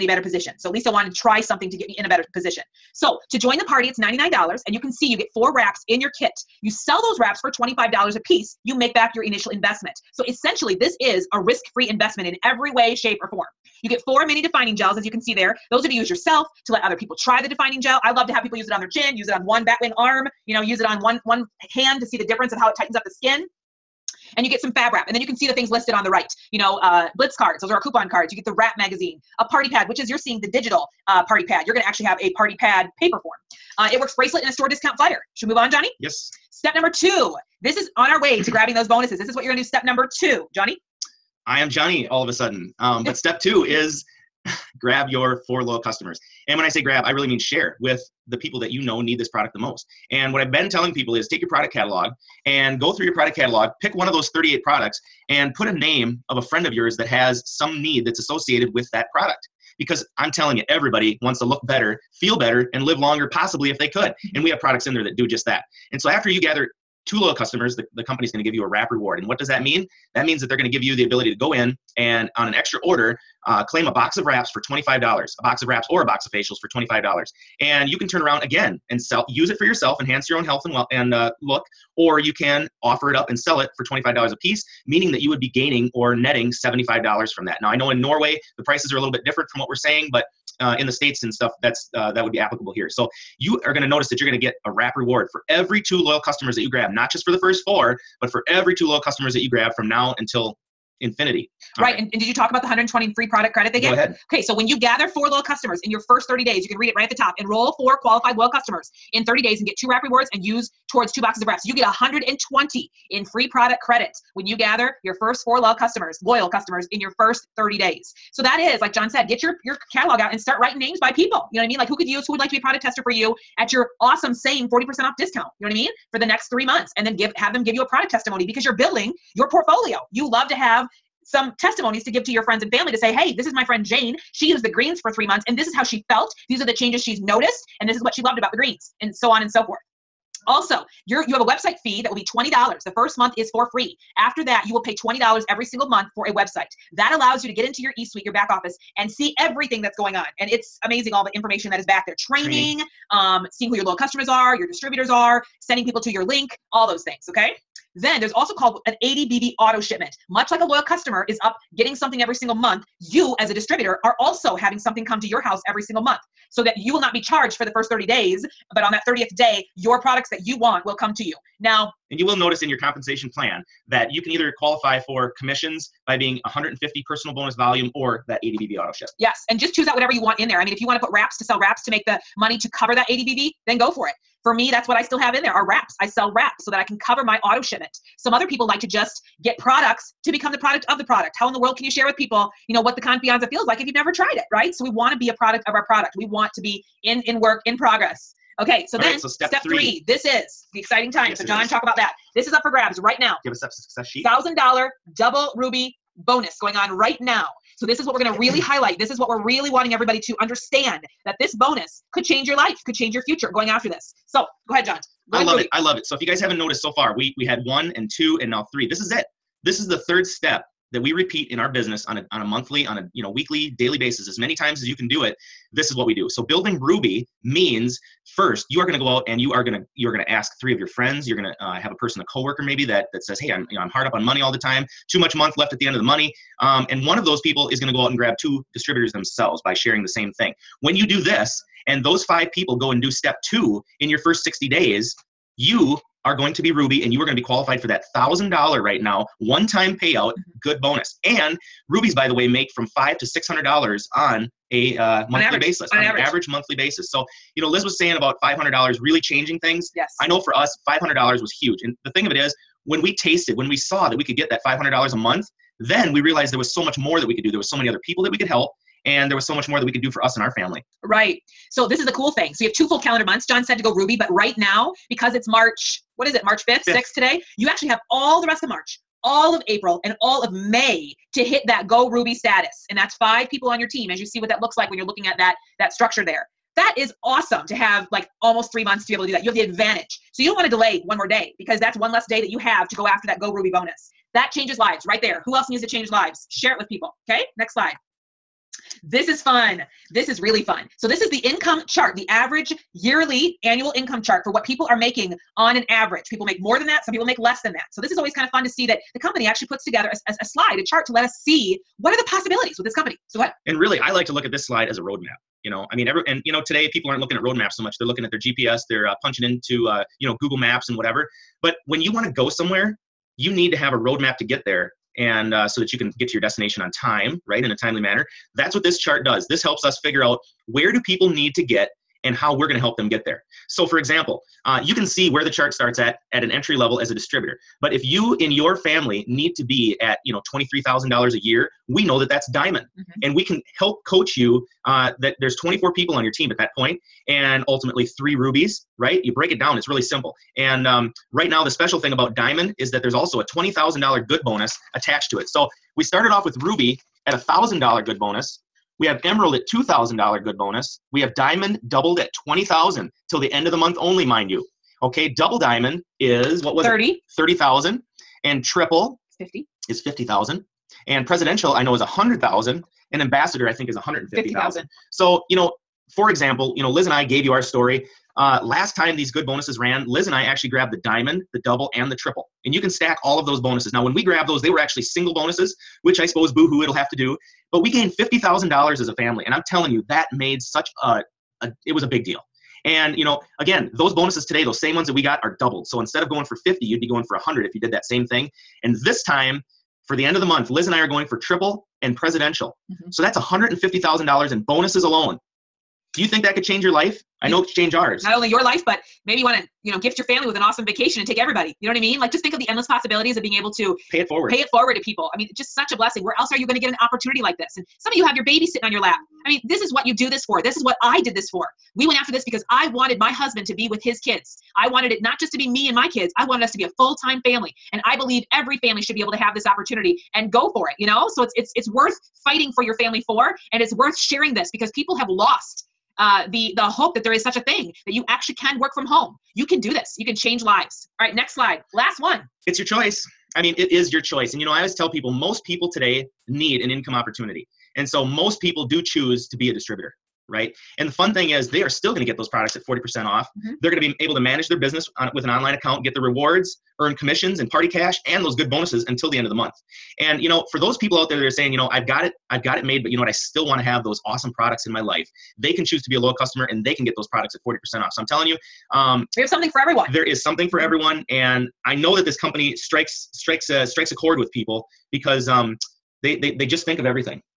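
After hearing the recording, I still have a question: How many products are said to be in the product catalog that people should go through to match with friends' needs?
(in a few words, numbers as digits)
38.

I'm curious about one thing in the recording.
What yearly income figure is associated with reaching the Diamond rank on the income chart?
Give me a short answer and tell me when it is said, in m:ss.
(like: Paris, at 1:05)
$23,000, at 5:40.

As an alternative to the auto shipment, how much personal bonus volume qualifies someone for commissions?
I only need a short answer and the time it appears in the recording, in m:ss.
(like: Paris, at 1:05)
150, at 2:56.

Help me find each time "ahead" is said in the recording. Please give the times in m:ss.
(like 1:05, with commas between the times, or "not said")
1:43, 3:34, 5:13.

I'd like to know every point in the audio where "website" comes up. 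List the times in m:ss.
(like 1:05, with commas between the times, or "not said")
2:21, 2:26.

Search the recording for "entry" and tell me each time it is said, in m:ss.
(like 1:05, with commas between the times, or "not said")
5:36.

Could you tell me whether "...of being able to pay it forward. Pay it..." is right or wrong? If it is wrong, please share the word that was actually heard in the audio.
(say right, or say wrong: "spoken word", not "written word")
right.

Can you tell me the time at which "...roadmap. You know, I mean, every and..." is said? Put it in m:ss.
5:14.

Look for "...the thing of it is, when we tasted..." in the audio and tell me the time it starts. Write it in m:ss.
4:22.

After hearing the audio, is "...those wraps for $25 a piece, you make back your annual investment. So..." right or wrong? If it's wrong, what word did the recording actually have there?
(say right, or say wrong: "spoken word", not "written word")
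wrong: "initial", not "annual".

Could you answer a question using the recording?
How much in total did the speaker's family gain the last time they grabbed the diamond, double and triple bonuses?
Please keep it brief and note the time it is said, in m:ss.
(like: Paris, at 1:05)
$50,000, at 6:28.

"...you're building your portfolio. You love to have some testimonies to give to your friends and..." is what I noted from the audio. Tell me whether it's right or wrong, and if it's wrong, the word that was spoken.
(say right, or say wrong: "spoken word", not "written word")
right.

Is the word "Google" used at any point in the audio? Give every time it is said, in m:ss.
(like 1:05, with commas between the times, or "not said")
5:20.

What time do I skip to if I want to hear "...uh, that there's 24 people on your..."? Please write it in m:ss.
5:44.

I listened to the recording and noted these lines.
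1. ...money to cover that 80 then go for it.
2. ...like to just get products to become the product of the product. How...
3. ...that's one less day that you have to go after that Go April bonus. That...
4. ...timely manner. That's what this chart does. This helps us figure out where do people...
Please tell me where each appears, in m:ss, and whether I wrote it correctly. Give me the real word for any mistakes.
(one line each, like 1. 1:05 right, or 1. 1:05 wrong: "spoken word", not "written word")
1. 3:02 right
2. 3:08 right
3. 4:51 wrong: "Ruby", not "April"
4. 5:27 right.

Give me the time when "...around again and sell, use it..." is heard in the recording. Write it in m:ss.
1:18.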